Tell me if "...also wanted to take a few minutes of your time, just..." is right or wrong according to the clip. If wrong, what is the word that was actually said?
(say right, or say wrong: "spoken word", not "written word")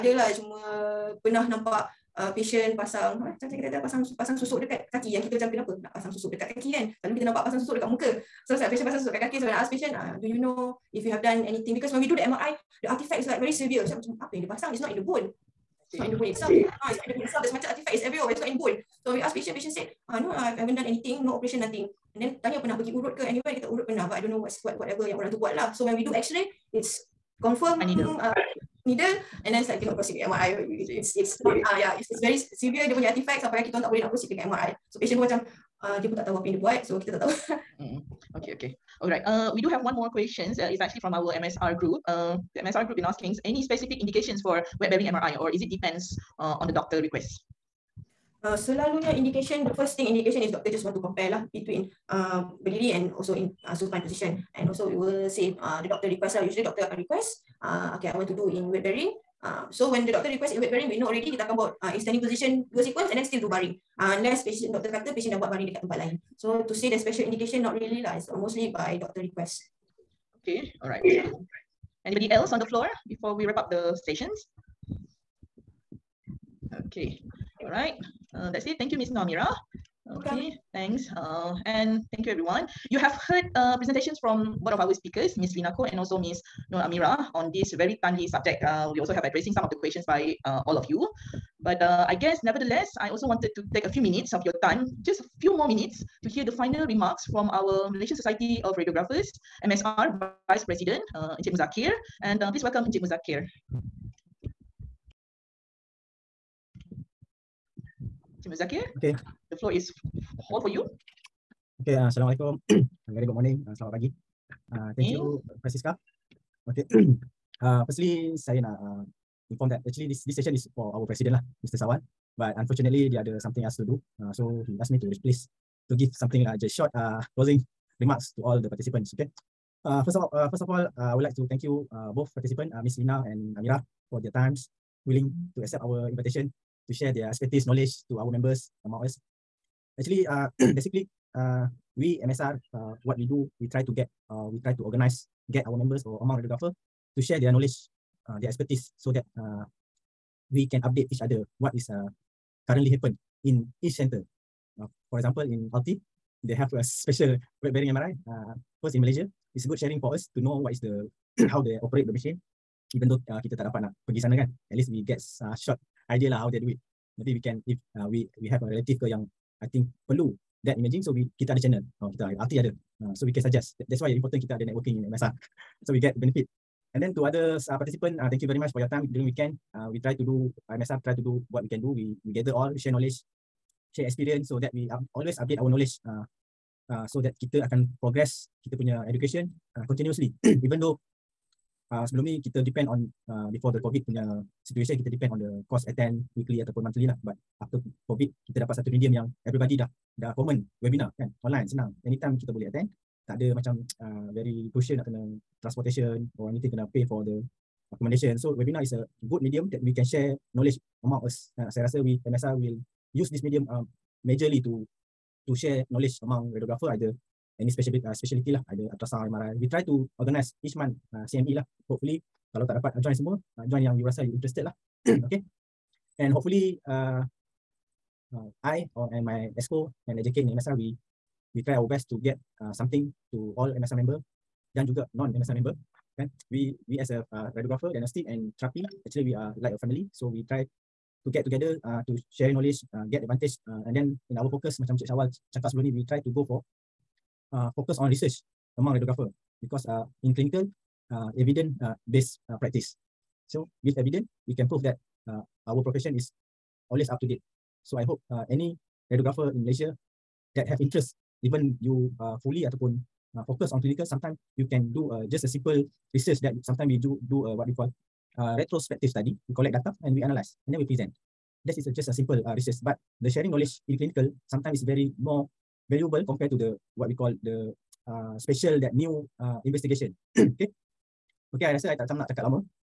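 right.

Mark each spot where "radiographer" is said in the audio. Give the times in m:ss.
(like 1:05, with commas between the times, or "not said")
1:38, 2:26, 3:36, 3:57, 4:08, 4:19.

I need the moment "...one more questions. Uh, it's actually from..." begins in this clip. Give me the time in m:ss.
0:39.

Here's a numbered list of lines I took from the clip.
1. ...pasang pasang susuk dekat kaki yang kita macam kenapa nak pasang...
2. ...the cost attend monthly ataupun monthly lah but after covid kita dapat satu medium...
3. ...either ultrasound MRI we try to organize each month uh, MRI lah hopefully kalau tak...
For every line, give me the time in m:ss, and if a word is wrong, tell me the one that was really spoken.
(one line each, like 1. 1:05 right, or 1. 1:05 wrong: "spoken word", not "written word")
1. 0:03 right
2. 3:15 wrong: "weekly", not "monthly"
3. 3:38 wrong: "CME", not "MRI".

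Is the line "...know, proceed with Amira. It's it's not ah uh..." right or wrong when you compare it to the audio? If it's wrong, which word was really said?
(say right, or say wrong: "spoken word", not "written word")
wrong: "MRI", not "Amira".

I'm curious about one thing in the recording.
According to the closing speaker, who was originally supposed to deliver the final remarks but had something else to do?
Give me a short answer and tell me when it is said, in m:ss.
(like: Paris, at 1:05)
Mr. Sawan, at 2:01.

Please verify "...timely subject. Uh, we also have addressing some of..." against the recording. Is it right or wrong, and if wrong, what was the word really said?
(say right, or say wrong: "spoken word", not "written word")
right.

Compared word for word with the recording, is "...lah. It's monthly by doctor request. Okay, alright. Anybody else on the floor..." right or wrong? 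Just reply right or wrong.
wrong.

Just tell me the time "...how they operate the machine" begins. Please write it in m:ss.
2:41.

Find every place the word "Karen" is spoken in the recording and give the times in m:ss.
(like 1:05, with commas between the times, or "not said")
not said.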